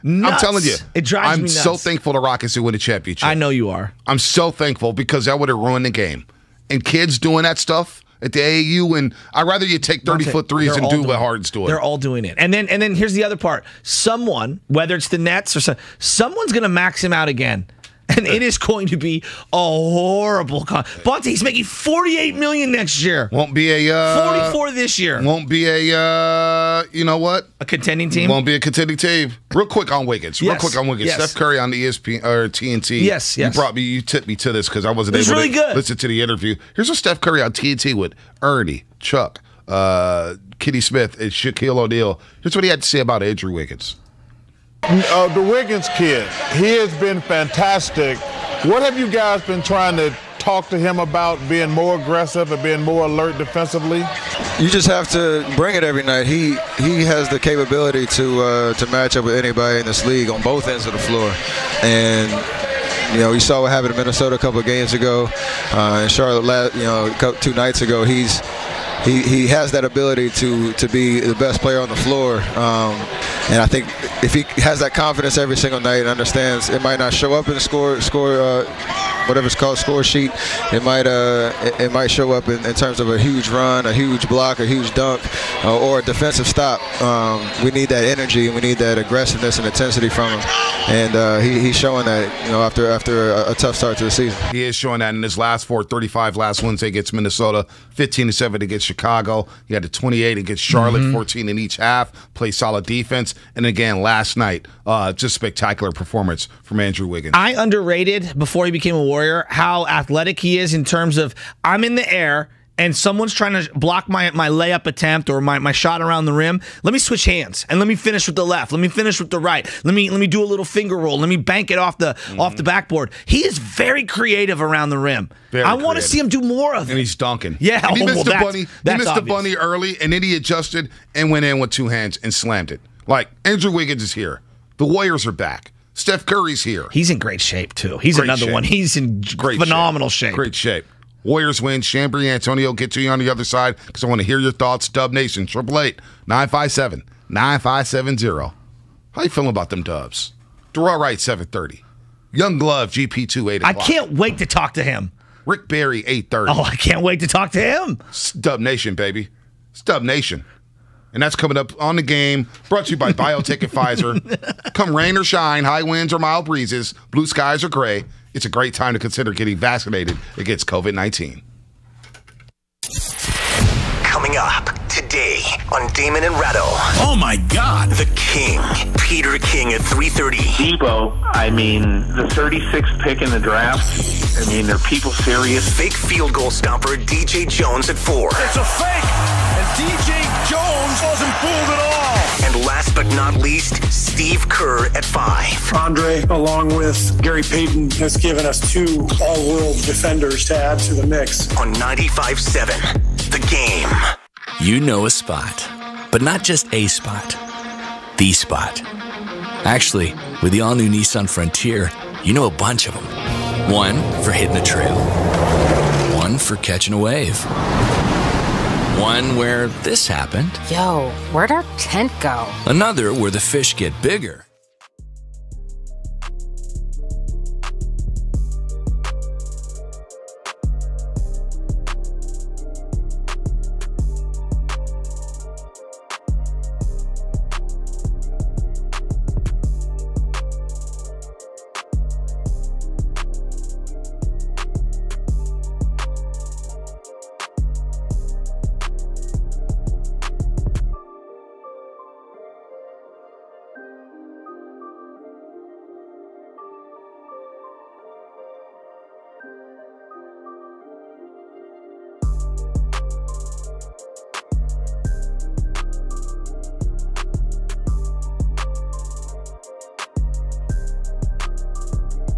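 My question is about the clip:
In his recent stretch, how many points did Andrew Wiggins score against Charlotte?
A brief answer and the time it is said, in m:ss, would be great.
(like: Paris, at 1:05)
28, at 1:39.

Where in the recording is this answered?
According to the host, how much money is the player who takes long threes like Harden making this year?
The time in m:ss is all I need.
0:24.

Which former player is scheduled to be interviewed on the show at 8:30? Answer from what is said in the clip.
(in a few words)
Rick Barry.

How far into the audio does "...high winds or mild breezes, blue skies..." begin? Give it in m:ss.
2:45.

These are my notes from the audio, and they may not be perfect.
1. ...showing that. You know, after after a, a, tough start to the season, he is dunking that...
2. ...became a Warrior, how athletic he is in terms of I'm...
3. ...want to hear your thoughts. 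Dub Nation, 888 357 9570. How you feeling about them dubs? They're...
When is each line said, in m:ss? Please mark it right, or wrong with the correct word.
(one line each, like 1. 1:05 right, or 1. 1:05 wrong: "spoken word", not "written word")
1. 1:31 wrong: "showing", not "dunking"
2. 1:48 right
3. 2:24 wrong: "957", not "357".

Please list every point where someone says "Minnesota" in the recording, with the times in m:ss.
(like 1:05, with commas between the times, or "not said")
1:03, 1:37.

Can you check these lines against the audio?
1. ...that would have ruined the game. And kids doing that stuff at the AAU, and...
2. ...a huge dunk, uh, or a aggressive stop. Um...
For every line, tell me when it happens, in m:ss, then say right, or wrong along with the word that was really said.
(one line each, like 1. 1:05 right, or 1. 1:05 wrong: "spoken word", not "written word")
1. 0:05 right
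2. 1:24 wrong: "defensive", not "aggressive".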